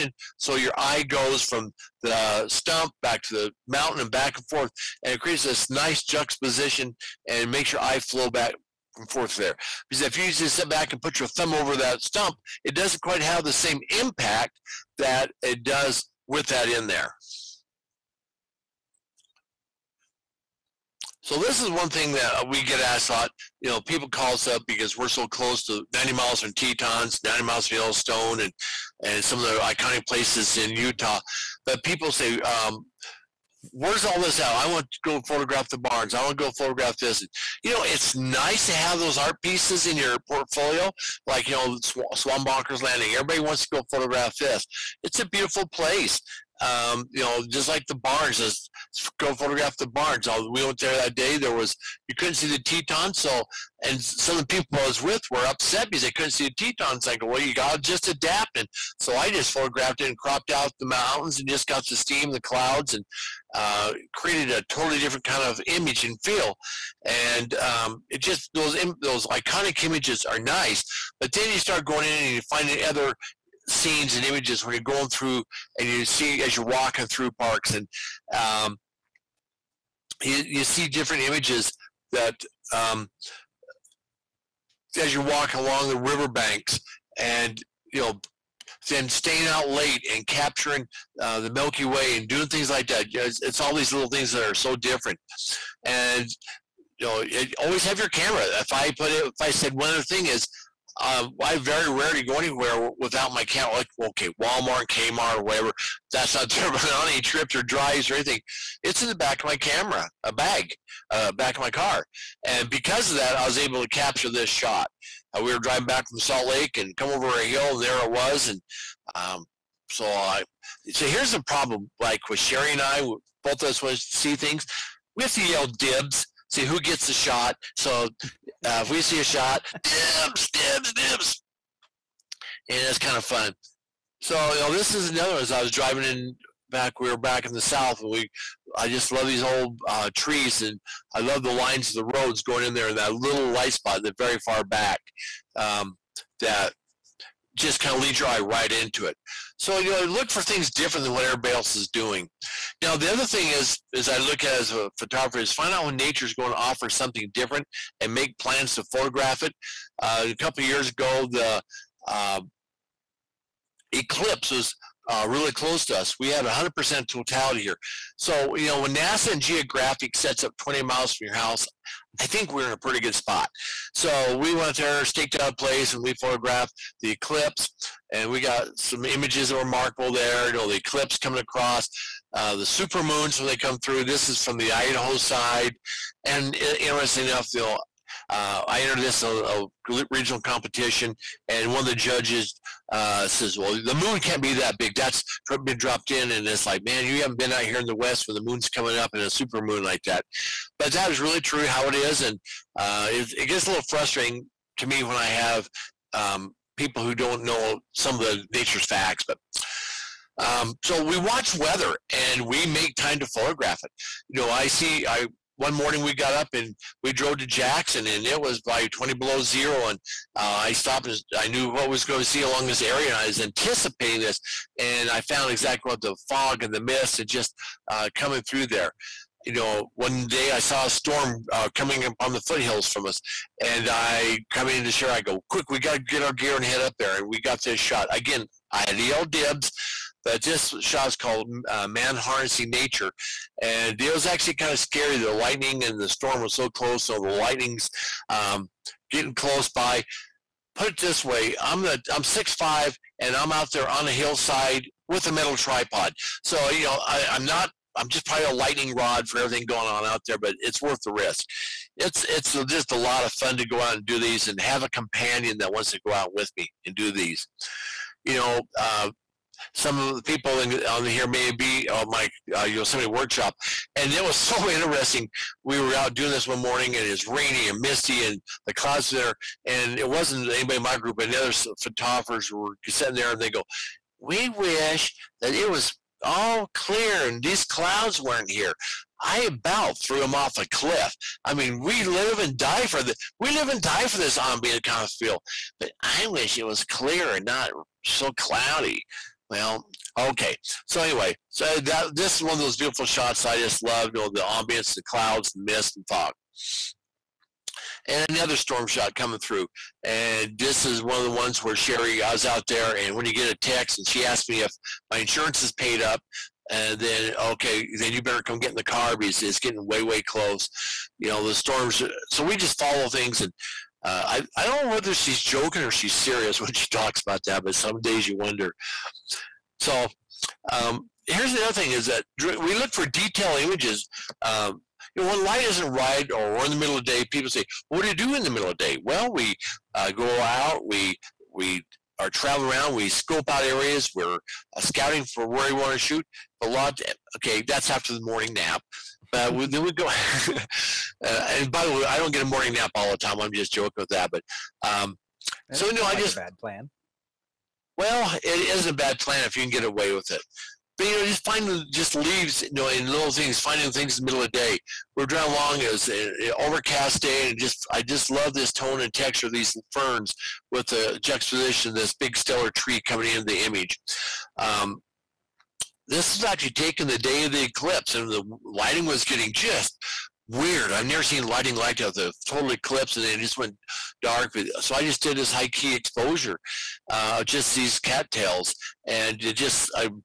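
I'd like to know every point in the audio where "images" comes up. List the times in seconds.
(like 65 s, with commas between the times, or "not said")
65 s, 69 s, 74 s, 81 s, 179 s, 333 s, 373 s.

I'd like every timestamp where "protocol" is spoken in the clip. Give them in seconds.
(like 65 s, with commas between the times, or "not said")
not said.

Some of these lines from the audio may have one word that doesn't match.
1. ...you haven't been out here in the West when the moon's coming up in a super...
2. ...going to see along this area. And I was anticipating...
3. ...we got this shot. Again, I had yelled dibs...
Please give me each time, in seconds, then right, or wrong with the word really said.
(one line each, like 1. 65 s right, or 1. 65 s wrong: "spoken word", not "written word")
1. 197 s right
2. 222 s right
3. 237 s right.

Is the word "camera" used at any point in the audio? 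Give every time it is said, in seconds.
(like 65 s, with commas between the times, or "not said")
98 s, 103 s, 109 s.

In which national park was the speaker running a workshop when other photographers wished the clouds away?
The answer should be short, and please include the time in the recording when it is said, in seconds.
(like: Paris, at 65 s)
Yosemite, at 272 s.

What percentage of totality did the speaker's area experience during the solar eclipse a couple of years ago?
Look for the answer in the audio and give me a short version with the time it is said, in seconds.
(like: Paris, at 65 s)
100%, at 166 s.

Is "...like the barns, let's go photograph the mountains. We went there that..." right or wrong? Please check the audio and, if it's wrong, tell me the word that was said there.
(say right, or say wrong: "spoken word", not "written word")
wrong: "barns", not "mountains".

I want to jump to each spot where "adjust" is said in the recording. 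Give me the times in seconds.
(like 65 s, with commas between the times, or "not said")
not said.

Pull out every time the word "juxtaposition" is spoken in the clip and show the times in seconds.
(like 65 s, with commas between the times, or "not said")
6 s, 371 s.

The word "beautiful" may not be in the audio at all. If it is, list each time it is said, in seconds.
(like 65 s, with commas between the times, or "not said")
45 s, 302 s.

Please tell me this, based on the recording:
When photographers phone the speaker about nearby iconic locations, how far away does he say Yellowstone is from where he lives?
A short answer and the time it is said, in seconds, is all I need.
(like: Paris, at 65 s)
90 miles, at 27 s.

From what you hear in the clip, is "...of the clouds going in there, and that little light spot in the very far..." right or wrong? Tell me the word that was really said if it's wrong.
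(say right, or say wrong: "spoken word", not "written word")
wrong: "roads", not "clouds".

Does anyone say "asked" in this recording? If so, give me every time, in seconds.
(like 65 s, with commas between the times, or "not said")
22 s, 314 s.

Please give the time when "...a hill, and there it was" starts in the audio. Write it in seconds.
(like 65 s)
117 s.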